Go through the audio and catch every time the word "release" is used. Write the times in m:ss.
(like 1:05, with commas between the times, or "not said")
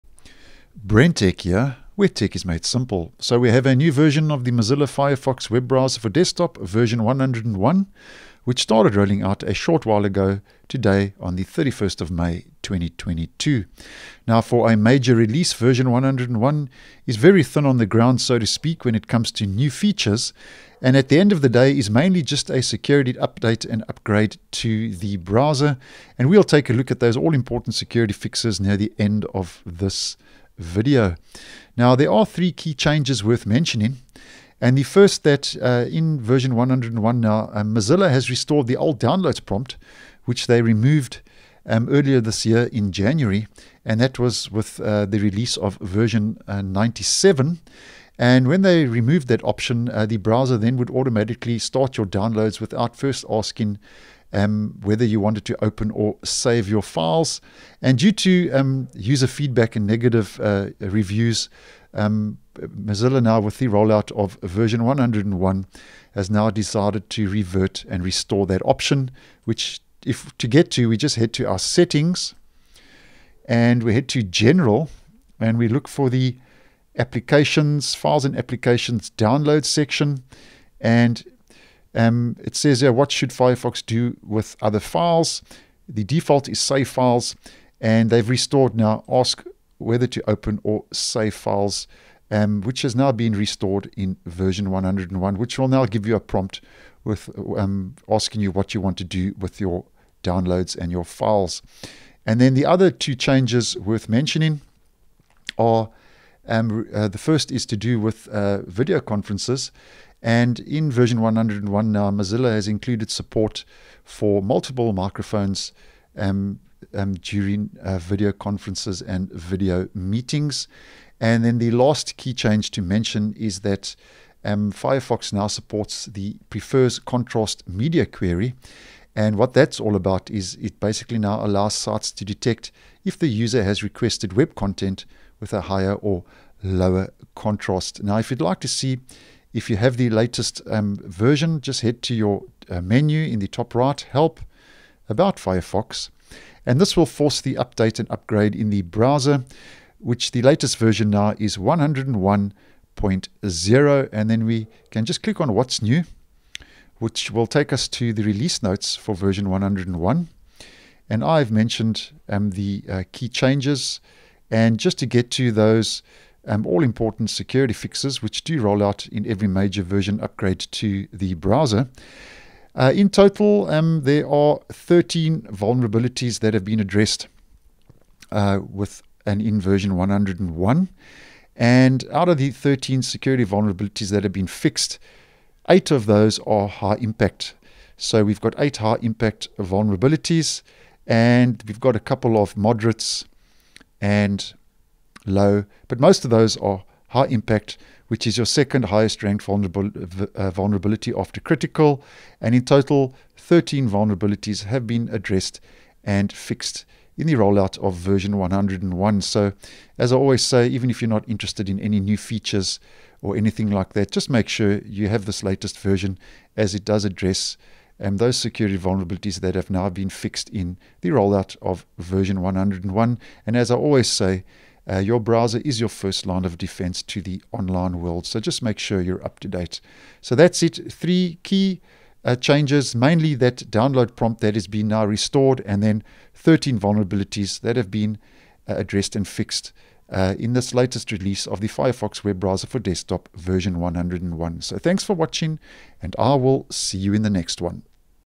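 0:15, 0:45, 2:38, 4:01.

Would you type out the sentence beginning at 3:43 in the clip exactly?
And as I always say, uh, your browser is your first line of defense to the online world.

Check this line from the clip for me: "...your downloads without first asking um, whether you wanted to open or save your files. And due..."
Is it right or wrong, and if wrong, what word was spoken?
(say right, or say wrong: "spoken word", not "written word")
right.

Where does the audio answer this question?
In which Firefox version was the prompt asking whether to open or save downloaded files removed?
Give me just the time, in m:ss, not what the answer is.
0:46.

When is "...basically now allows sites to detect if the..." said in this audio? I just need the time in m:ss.
2:10.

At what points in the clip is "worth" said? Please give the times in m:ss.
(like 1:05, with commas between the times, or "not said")
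0:33, 1:43.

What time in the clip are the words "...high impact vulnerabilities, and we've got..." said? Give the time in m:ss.
3:08.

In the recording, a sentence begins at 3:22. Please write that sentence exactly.
And in total, 13 vulnerabilities have been addressed and fixed in the rollout of version 101.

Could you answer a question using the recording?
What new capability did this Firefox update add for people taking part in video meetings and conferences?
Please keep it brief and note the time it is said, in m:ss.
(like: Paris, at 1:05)
Multiple microphones, at 1:54.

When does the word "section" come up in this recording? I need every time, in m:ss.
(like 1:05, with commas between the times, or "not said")
1:19.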